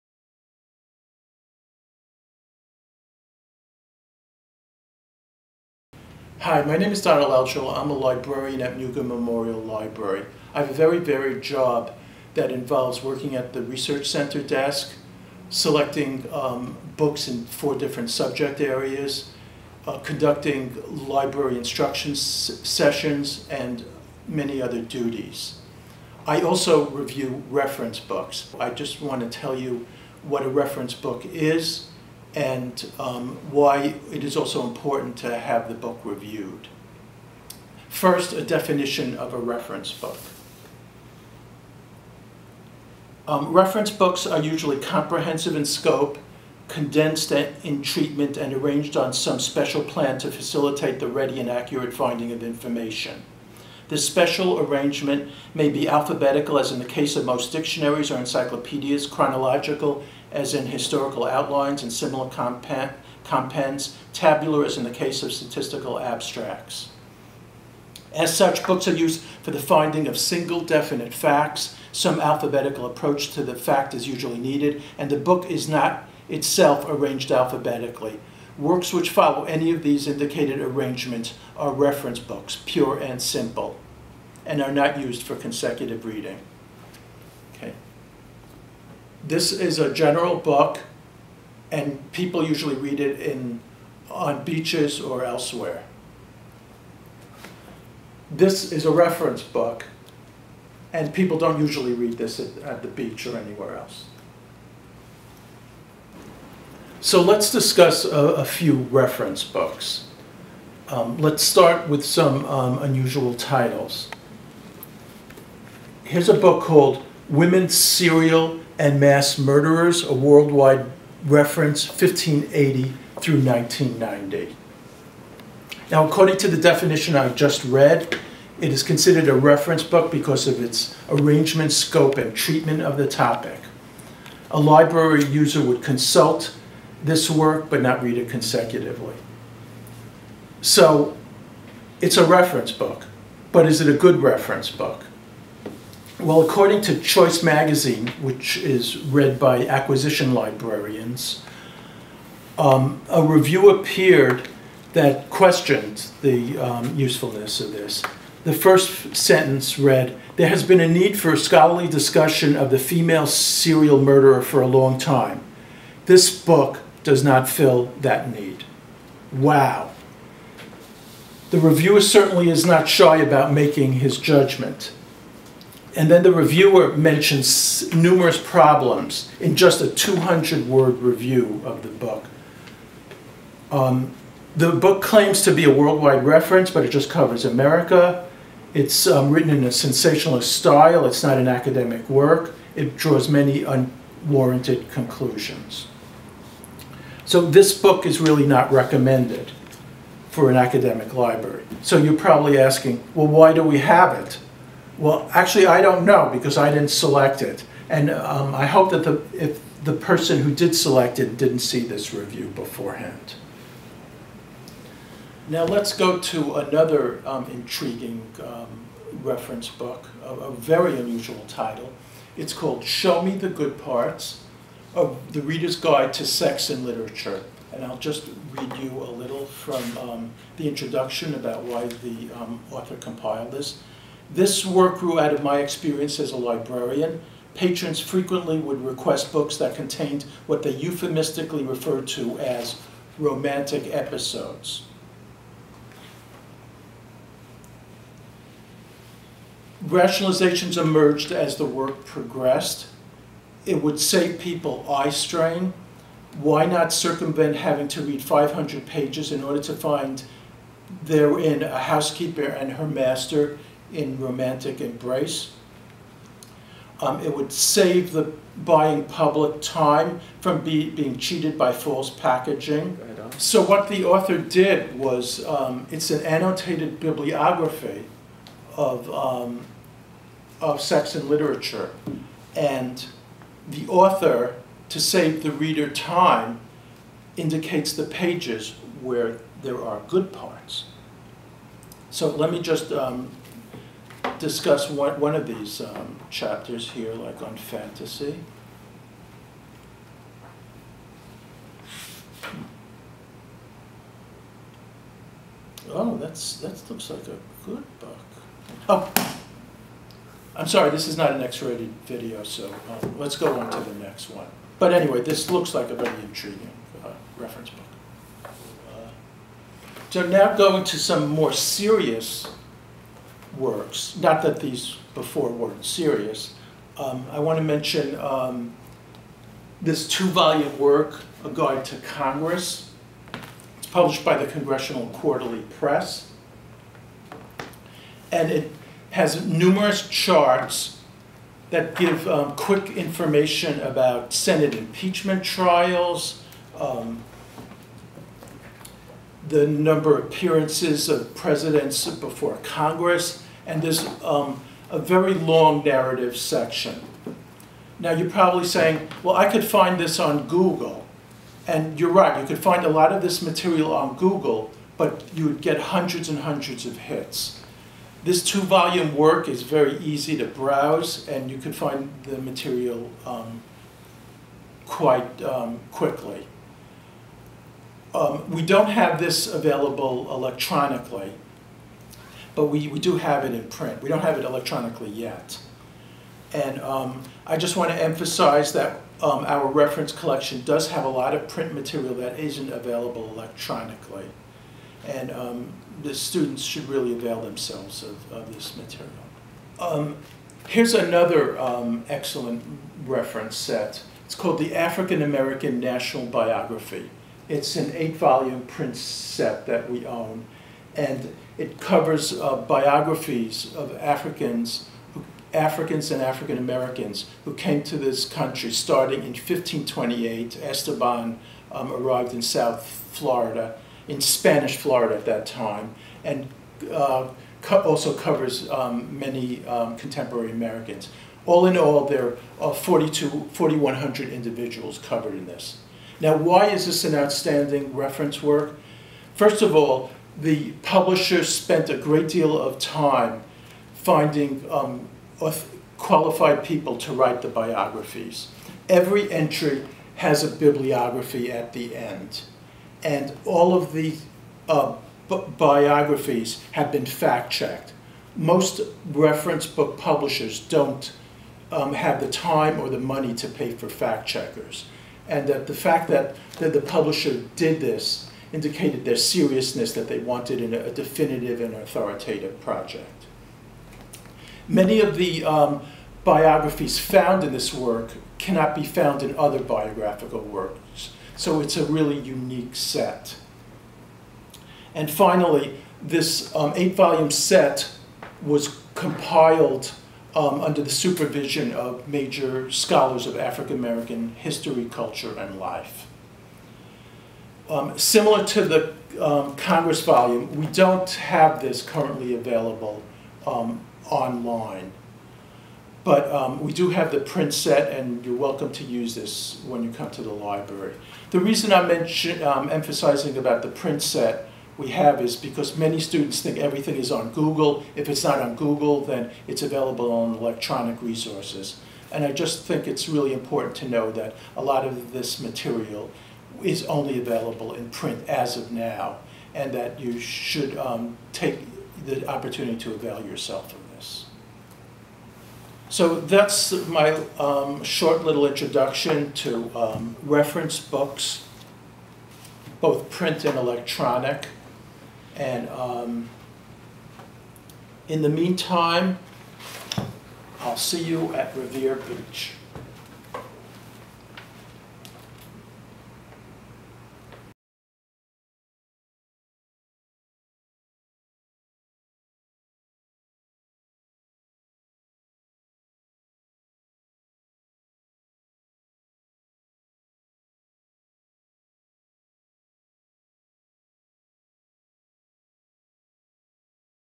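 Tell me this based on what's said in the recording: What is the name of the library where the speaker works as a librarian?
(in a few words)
Mugar Memorial Library.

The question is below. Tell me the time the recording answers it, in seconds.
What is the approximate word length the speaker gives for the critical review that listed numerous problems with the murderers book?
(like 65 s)
179 s.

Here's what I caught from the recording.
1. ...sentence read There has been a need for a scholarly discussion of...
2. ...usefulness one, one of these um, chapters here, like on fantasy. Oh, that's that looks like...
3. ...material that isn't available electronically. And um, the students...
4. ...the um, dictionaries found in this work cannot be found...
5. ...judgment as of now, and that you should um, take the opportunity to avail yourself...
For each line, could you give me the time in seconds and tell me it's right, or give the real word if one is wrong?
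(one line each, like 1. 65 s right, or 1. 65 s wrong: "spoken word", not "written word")
1. 159 s right
2. 294 s wrong: "discuss", not "usefulness"
3. 391 s right
4. 475 s wrong: "biographies", not "dictionaries"
5. 527 s wrong: "print", not "judgment".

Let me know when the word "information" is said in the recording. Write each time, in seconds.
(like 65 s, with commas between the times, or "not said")
52 s, 342 s.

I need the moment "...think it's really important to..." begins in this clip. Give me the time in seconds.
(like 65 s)
522 s.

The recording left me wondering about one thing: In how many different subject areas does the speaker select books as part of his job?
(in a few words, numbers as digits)
4.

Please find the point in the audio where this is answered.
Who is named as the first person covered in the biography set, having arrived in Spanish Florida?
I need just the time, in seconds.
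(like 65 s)
420 s.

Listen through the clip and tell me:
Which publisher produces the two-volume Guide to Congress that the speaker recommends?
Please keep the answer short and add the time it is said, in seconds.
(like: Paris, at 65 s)
Congressional Quarterly Press, at 334 s.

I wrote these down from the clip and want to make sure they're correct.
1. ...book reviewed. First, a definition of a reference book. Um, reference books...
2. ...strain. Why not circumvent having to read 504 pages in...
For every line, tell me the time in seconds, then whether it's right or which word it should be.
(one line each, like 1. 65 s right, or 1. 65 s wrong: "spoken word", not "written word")
1. 35 s right
2. 255 s wrong: "500", not "504".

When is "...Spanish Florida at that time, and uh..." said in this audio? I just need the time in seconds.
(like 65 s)
424 s.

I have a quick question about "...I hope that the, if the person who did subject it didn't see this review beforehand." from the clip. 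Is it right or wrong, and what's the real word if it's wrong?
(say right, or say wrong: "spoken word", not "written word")
wrong: "select", not "subject".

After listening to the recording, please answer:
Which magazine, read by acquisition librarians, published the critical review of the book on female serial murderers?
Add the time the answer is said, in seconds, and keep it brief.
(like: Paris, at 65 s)
Choice Magazine, at 146 s.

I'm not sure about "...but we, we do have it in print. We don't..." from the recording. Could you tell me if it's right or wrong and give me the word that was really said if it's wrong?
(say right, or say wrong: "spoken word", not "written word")
right.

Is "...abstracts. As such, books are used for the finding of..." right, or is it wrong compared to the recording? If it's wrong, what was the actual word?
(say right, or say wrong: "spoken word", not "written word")
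right.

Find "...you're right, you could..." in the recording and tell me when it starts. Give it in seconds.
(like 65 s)
361 s.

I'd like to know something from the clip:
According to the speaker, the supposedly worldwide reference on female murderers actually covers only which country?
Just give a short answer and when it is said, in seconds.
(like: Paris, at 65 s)
America, at 187 s.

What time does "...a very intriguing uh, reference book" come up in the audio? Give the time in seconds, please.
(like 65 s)
315 s.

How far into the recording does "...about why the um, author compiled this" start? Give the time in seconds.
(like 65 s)
231 s.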